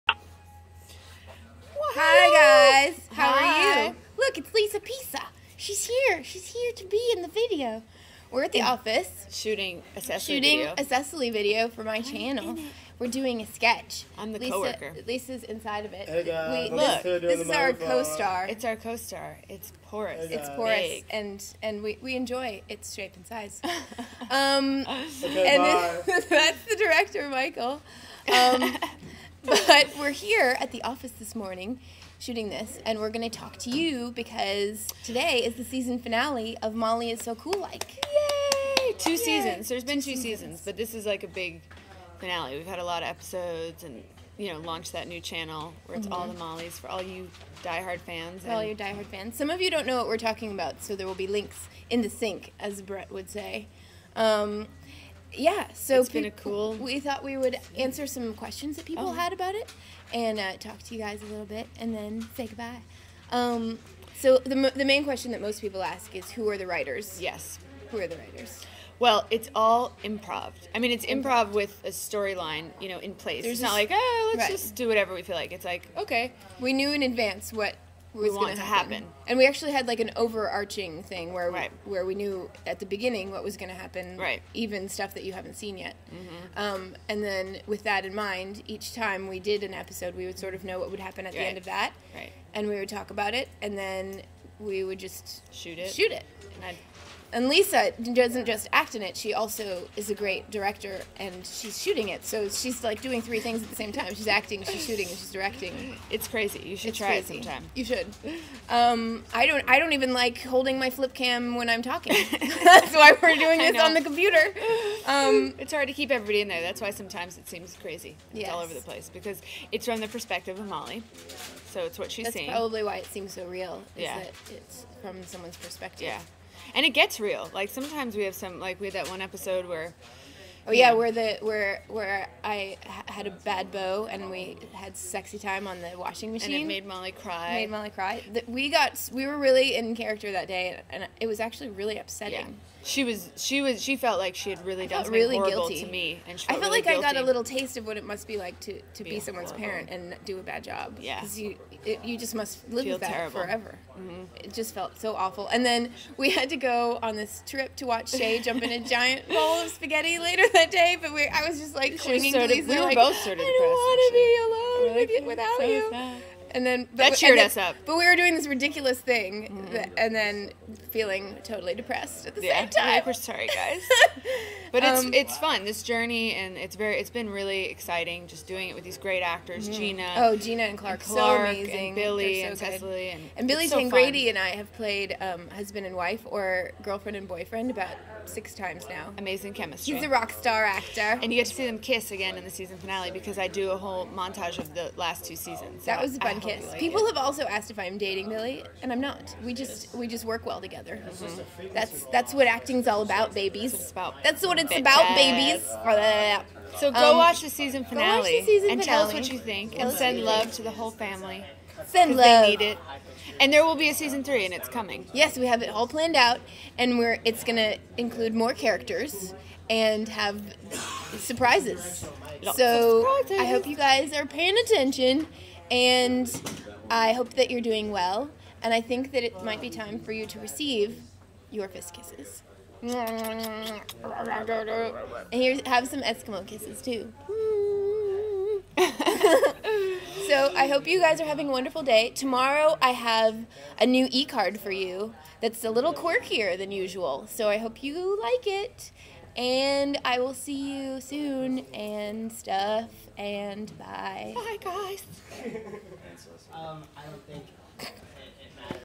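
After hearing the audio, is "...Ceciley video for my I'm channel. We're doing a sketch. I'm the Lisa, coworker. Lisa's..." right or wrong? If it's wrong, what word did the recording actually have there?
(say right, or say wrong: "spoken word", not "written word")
right.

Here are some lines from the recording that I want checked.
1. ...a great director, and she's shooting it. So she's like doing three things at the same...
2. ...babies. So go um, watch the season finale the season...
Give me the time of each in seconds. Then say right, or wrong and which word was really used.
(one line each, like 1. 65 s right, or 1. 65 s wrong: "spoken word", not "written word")
1. 100 s right
2. 205 s right.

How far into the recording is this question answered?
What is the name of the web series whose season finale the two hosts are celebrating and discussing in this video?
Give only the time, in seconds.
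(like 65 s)
36 s.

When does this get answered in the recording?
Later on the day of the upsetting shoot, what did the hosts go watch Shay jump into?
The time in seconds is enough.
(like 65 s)
158 s.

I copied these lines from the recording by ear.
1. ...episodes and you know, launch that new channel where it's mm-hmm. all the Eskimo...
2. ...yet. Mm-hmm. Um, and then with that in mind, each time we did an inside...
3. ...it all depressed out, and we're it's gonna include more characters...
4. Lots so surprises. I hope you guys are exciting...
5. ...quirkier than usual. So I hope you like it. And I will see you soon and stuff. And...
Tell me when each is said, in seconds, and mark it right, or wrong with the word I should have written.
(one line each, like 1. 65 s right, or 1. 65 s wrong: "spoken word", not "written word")
1. 43 s wrong: "Mollies", not "Eskimo"
2. 85 s wrong: "episode", not "inside"
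3. 215 s wrong: "planned", not "depressed"
4. 222 s wrong: "paying", not "exciting"
5. 245 s right.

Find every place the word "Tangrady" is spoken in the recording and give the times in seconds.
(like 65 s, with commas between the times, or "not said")
183 s.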